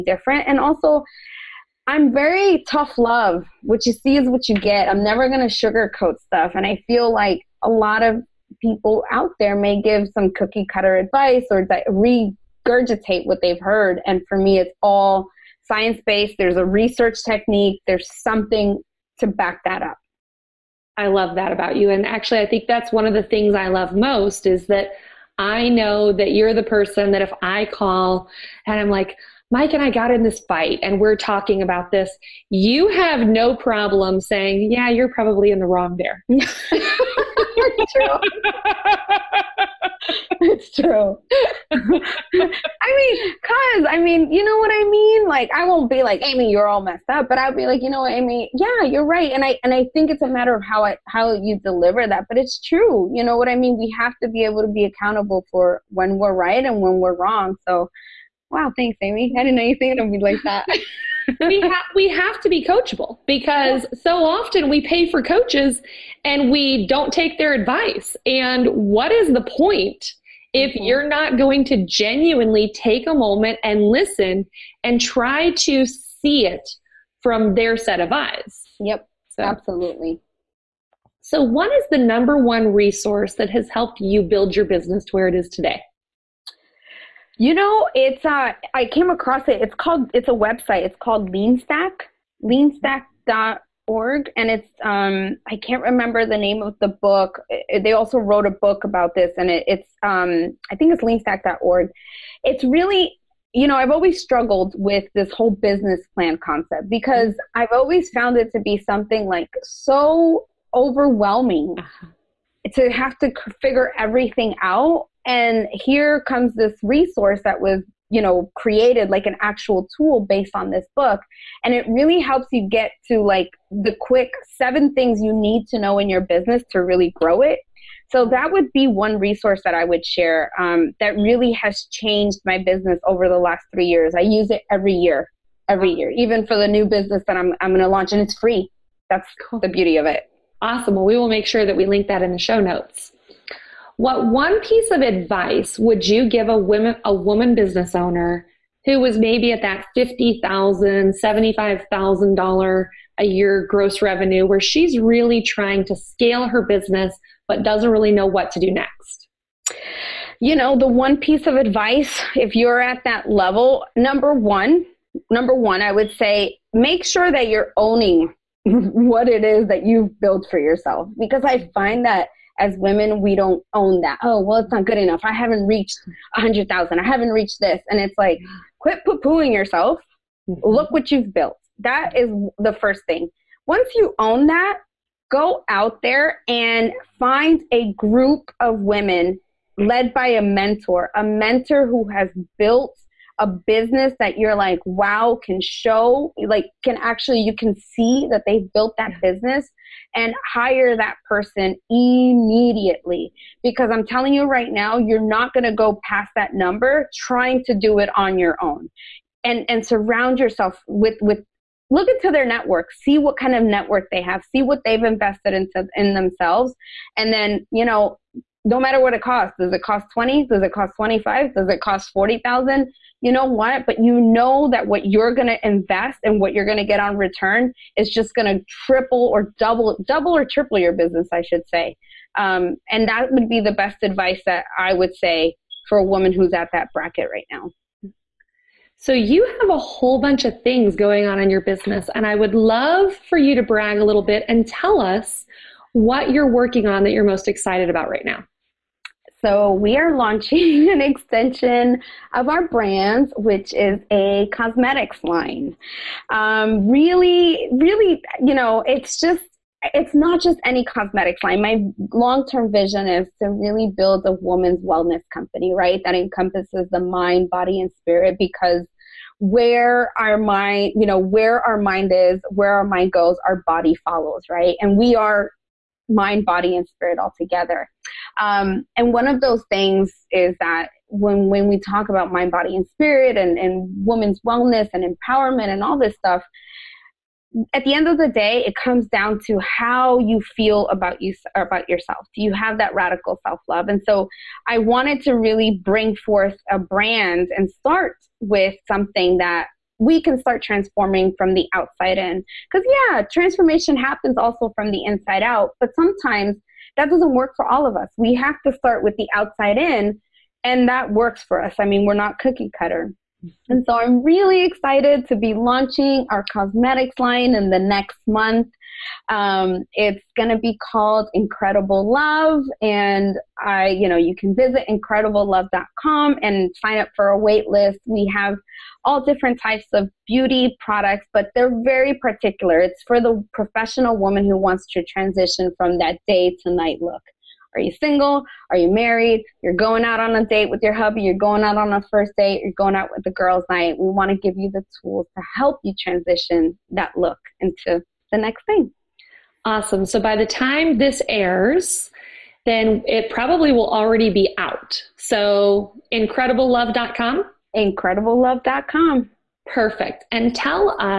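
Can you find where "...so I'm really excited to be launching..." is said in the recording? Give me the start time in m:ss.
5:13.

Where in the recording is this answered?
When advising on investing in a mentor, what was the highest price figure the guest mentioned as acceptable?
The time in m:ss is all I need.
3:42.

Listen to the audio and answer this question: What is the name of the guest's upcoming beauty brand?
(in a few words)
Incredible Love.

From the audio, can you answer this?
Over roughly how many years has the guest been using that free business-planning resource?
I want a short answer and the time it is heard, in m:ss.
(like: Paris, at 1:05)
3, at 2:13.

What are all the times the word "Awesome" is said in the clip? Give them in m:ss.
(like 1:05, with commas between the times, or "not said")
2:20, 5:49.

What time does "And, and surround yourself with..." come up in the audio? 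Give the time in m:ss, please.
3:29.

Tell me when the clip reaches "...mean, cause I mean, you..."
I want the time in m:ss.
0:42.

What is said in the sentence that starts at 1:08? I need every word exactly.
And what is the point if mm-hmm.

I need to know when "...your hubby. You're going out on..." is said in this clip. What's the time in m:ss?
5:40.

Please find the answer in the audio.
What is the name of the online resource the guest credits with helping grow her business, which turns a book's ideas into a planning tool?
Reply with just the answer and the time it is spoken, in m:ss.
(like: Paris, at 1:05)
LeanStack, at 1:30.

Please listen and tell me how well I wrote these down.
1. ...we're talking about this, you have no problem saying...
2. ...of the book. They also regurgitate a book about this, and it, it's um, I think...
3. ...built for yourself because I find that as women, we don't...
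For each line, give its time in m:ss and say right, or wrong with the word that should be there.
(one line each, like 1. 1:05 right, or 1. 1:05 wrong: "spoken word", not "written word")
1. 0:30 right
2. 1:36 wrong: "wrote", not "regurgitate"
3. 2:50 right.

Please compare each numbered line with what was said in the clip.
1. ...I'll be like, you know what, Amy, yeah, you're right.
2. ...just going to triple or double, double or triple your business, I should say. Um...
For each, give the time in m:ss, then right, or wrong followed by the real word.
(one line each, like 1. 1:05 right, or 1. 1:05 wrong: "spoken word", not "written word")
1. 0:47 right
2. 3:48 right.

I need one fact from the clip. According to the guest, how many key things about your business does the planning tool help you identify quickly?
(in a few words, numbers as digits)
7.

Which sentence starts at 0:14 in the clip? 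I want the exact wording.
And for me, it's all science based.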